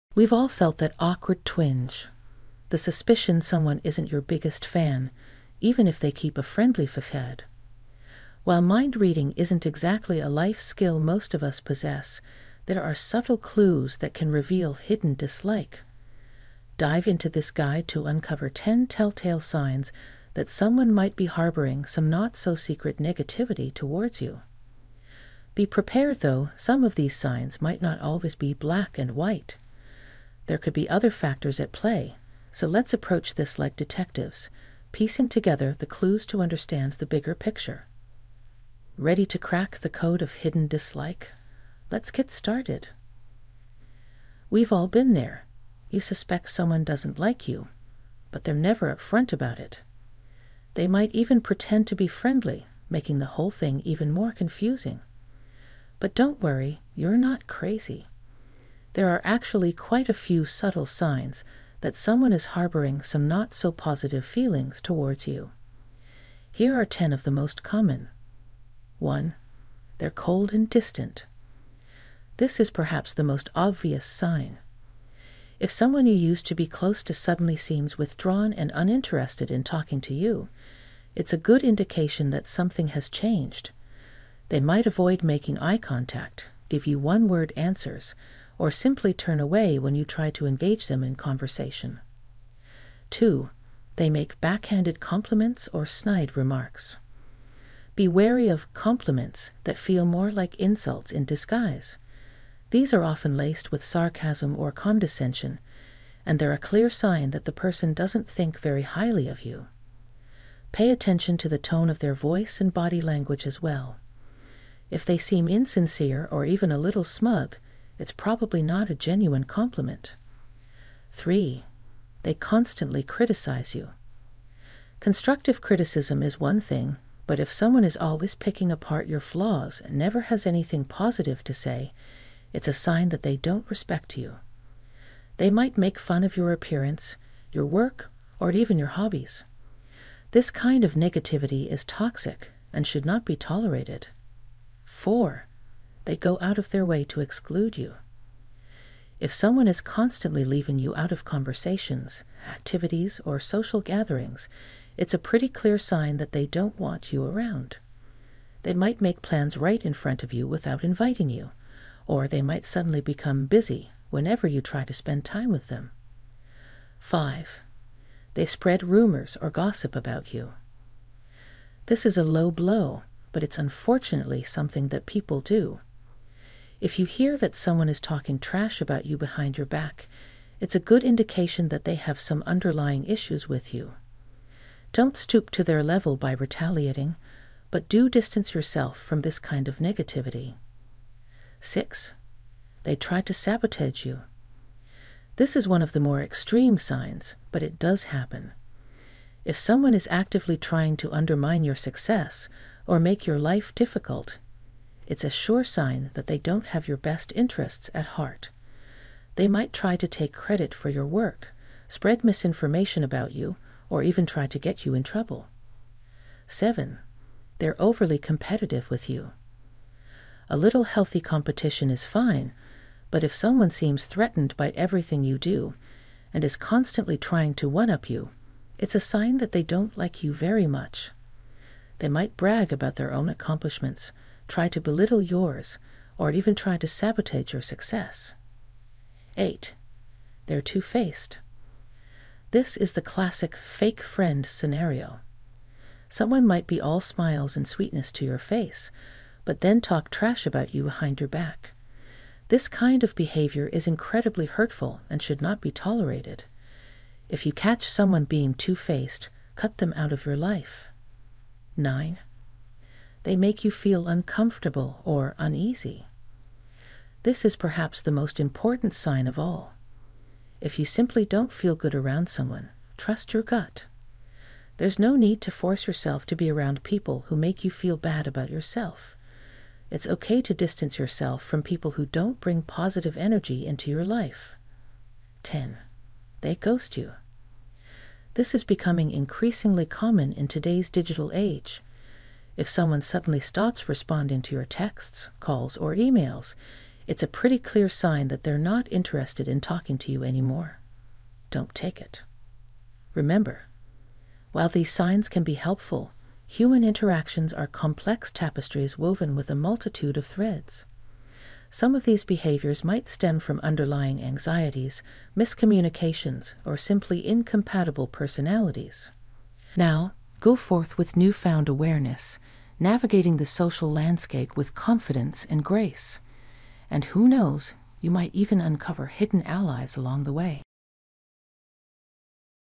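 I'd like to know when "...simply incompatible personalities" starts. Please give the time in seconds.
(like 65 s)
316 s.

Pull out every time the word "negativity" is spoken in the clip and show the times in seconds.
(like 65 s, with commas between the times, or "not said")
22 s, 140 s, 189 s.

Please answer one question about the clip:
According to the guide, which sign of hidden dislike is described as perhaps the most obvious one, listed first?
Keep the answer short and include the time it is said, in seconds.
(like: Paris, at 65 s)
Cold and distant, at 69 s.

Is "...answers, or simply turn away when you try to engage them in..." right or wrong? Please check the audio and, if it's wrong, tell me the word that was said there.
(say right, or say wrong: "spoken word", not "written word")
right.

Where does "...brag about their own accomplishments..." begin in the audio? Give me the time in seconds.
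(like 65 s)
232 s.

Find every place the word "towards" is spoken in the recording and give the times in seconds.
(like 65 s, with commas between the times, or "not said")
23 s, 64 s.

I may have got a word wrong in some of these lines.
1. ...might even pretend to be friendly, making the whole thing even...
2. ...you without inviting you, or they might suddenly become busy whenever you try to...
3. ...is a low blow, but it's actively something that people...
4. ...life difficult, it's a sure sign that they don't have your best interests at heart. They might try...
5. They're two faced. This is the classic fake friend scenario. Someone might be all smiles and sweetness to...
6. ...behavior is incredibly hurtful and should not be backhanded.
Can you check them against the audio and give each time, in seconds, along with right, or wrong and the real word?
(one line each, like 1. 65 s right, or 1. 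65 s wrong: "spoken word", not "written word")
1. 50 s right
2. 160 s right
3. 172 s wrong: "unfortunately", not "actively"
4. 203 s right
5. 240 s right
6. 253 s wrong: "tolerated", not "backhanded".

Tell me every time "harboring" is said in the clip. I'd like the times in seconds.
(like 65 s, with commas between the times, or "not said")
21 s, 62 s.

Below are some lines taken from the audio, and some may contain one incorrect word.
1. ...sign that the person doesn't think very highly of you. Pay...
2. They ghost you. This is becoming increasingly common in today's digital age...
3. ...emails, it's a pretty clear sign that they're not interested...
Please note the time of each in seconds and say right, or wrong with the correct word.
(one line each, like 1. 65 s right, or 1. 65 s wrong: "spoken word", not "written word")
1. 106 s right
2. 286 s right
3. 295 s right.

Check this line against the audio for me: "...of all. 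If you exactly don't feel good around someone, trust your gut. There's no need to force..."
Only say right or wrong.
wrong.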